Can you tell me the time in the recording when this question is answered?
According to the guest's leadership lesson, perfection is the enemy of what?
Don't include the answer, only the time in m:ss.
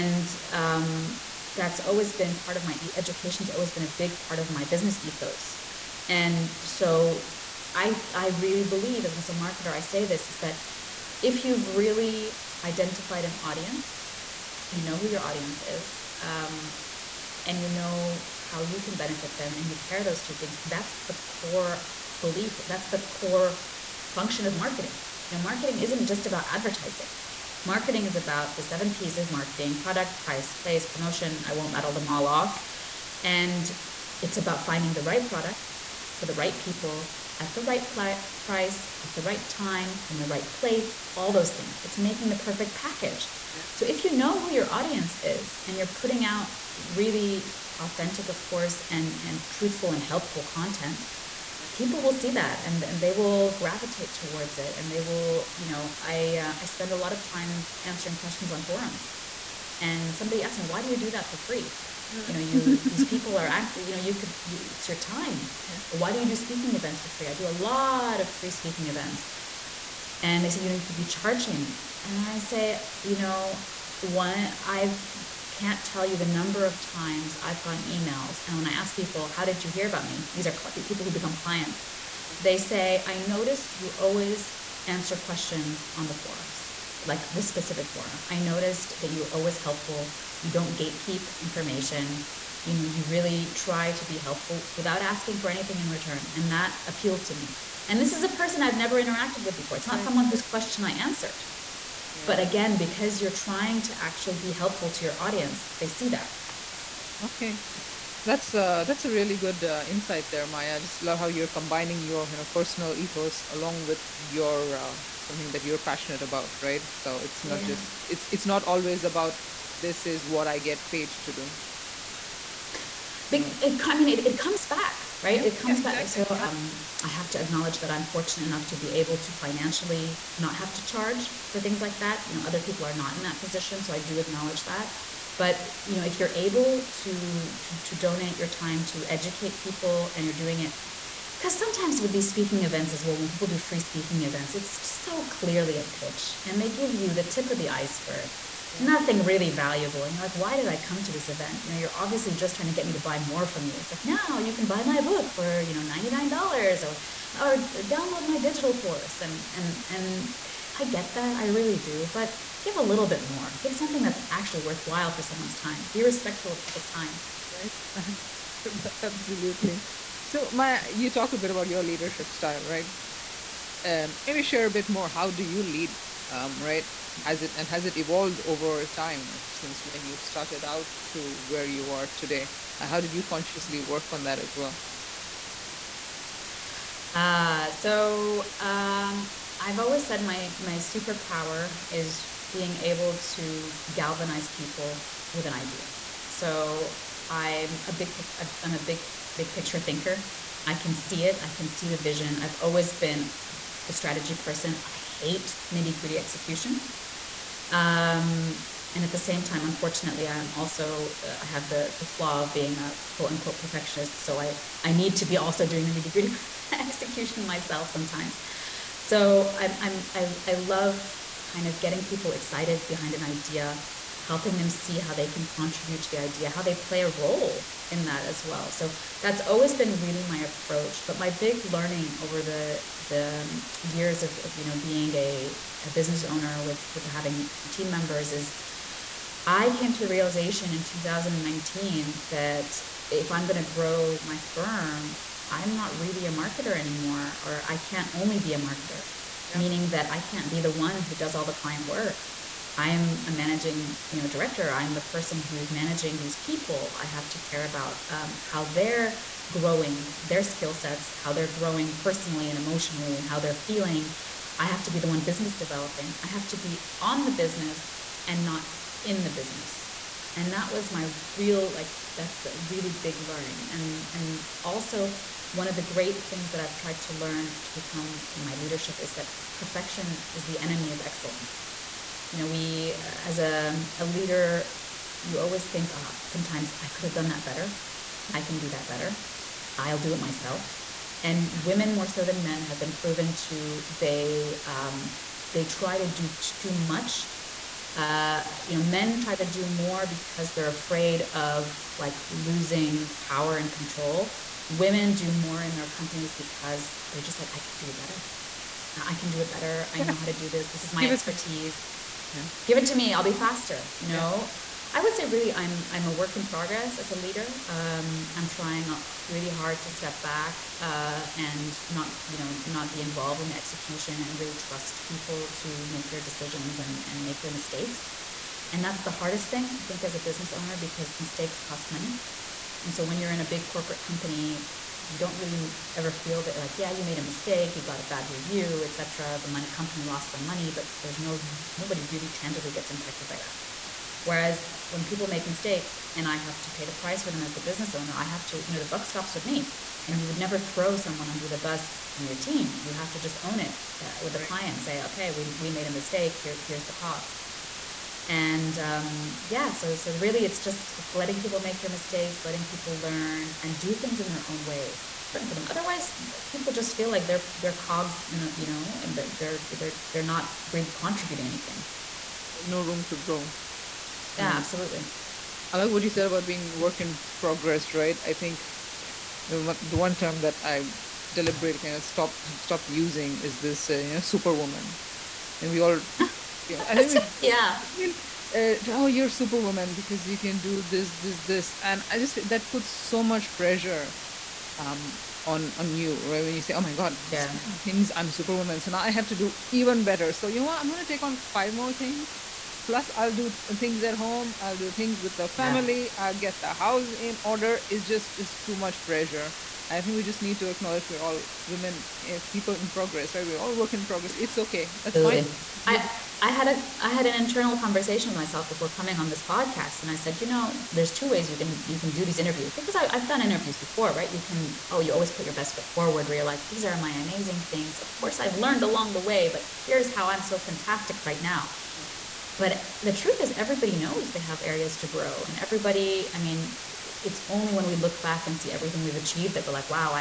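4:41.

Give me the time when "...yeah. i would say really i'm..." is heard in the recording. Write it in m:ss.
5:14.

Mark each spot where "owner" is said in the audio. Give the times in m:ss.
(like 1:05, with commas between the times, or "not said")
3:56, 5:30, 5:47.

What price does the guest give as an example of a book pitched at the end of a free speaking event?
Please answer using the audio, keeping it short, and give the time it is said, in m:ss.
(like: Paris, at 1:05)
$99, at 2:35.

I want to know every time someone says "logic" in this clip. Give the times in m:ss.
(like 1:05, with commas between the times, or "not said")
not said.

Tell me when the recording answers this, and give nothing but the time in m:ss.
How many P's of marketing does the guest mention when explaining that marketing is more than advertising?
0:28.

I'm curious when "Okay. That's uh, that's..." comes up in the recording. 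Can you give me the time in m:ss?
1:47.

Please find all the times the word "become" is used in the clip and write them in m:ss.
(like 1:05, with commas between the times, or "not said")
1:21, 4:37.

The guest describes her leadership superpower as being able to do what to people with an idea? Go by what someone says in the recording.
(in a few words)
Galvanize.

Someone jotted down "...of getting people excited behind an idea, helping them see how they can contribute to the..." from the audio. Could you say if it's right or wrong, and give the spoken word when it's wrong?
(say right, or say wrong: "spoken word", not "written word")
right.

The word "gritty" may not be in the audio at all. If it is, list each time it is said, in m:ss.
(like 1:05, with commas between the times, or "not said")
3:25, 3:36.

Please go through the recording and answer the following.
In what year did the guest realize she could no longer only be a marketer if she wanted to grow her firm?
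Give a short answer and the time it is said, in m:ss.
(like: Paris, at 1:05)
2019, at 4:00.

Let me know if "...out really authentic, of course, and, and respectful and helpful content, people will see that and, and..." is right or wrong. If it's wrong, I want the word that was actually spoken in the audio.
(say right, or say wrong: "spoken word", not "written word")
wrong: "truthful", not "respectful".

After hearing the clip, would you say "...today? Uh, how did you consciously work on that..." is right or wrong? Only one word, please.
right.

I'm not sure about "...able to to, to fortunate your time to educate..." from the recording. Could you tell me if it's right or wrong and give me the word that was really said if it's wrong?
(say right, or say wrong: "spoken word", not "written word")
wrong: "donate", not "fortunate".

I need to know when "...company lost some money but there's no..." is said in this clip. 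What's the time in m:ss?
5:39.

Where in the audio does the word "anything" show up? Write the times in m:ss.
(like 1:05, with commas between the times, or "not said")
1:35, 6:11.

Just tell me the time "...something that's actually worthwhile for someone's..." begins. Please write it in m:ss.
2:43.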